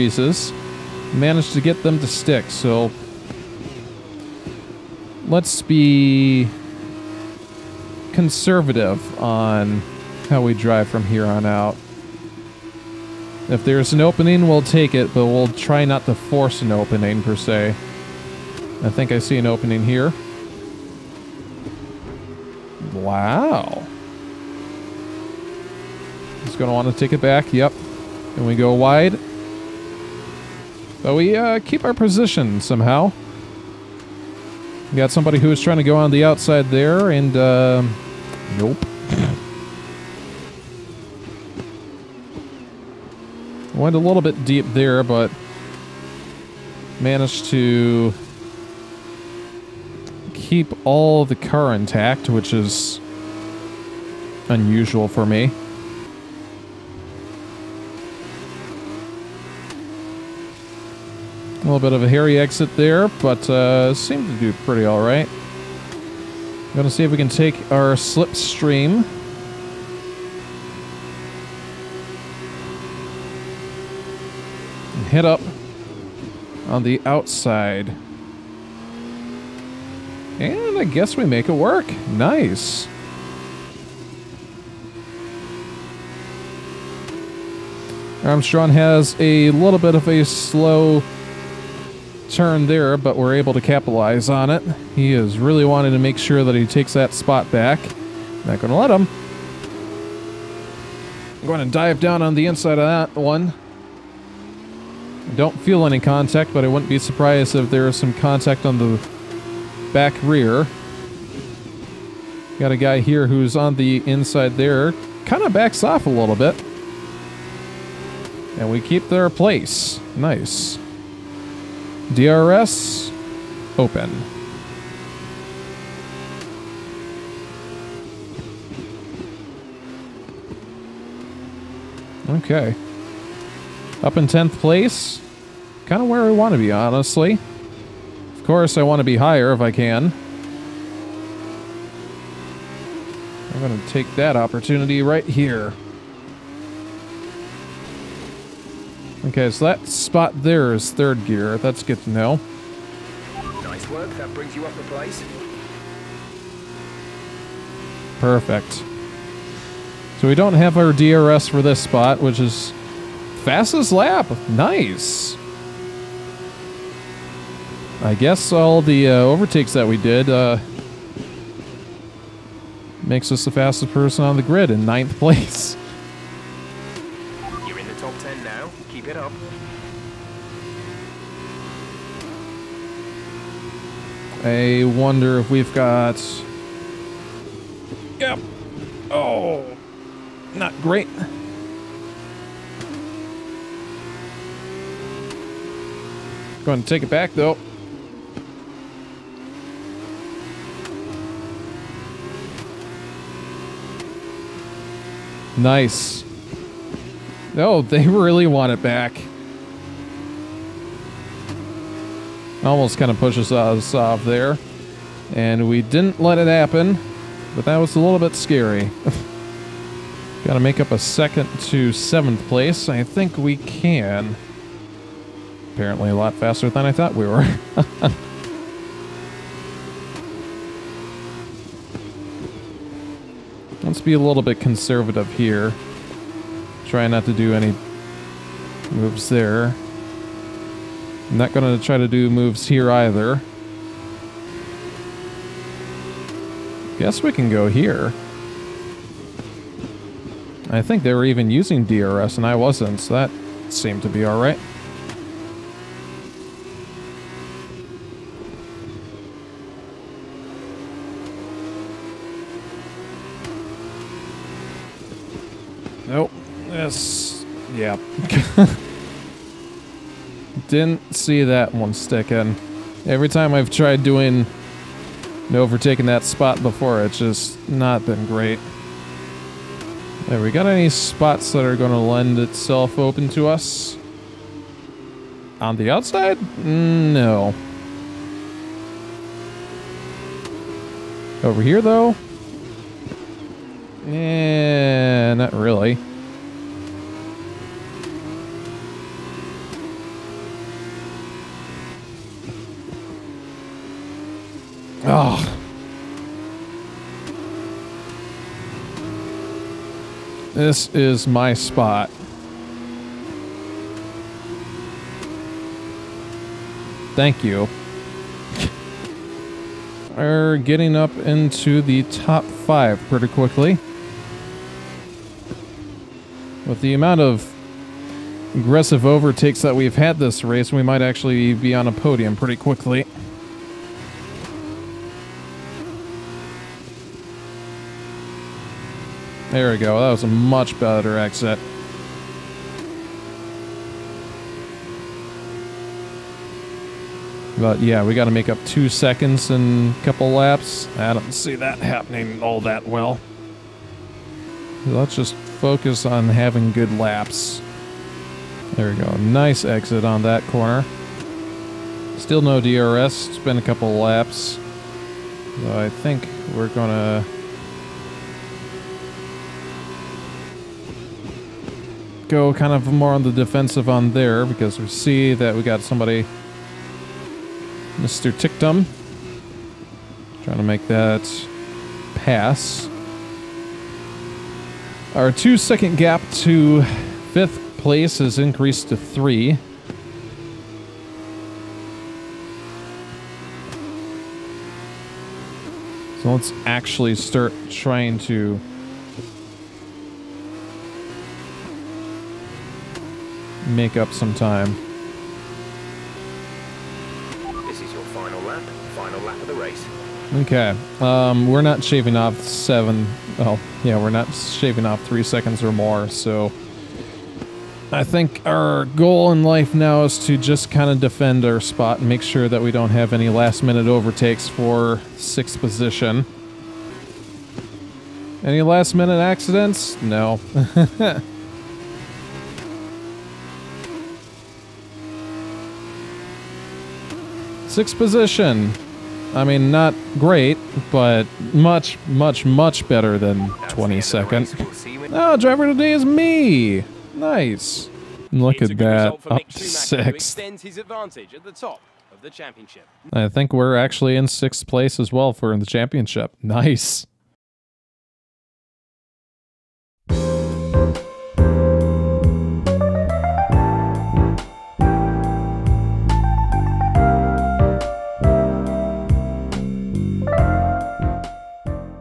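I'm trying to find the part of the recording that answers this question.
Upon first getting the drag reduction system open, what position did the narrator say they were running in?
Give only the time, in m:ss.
2:14.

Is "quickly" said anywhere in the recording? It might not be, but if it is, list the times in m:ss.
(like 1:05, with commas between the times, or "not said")
5:23, 5:32.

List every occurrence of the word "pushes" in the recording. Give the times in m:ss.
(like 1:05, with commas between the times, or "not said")
3:33.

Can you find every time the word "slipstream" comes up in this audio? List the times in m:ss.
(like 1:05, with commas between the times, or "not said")
1:07.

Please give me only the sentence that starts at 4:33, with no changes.
Every time I've tried doing overtaking that spot before, it's just not been great.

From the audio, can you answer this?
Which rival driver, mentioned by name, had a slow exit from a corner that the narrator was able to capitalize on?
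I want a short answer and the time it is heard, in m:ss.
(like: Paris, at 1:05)
Armstrong, at 1:28.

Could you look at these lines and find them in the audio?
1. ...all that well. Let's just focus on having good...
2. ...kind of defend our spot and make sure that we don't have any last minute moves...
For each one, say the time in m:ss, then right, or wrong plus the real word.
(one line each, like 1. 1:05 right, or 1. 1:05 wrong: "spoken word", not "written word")
1. 5:52 right
2. 7:00 wrong: "overtakes", not "moves".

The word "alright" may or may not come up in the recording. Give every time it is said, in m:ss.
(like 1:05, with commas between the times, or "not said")
1:04, 4:14.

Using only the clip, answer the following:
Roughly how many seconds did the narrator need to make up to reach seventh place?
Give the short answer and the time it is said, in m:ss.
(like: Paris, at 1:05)
1, at 3:40.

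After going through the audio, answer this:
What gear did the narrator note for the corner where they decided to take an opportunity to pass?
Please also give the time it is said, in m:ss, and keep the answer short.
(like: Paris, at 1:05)
Third gear, at 2:30.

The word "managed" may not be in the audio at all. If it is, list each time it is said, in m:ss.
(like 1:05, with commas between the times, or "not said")
0:01, 0:46.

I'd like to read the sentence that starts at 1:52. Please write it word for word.
Got a guy here who's on the inside there.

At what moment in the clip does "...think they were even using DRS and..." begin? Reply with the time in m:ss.
4:10.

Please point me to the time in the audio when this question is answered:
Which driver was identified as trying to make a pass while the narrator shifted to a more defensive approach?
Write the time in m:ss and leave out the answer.
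6:17.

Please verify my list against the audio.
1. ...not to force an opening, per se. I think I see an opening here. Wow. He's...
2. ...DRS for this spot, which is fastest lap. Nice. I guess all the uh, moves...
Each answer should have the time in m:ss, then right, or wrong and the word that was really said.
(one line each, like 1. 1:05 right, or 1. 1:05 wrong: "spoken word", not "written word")
1. 0:15 right
2. 2:40 wrong: "overtakes", not "moves".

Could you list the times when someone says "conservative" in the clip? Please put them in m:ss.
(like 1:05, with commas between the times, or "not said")
0:08, 3:54.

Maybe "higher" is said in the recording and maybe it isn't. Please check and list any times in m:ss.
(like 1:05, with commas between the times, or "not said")
2:19.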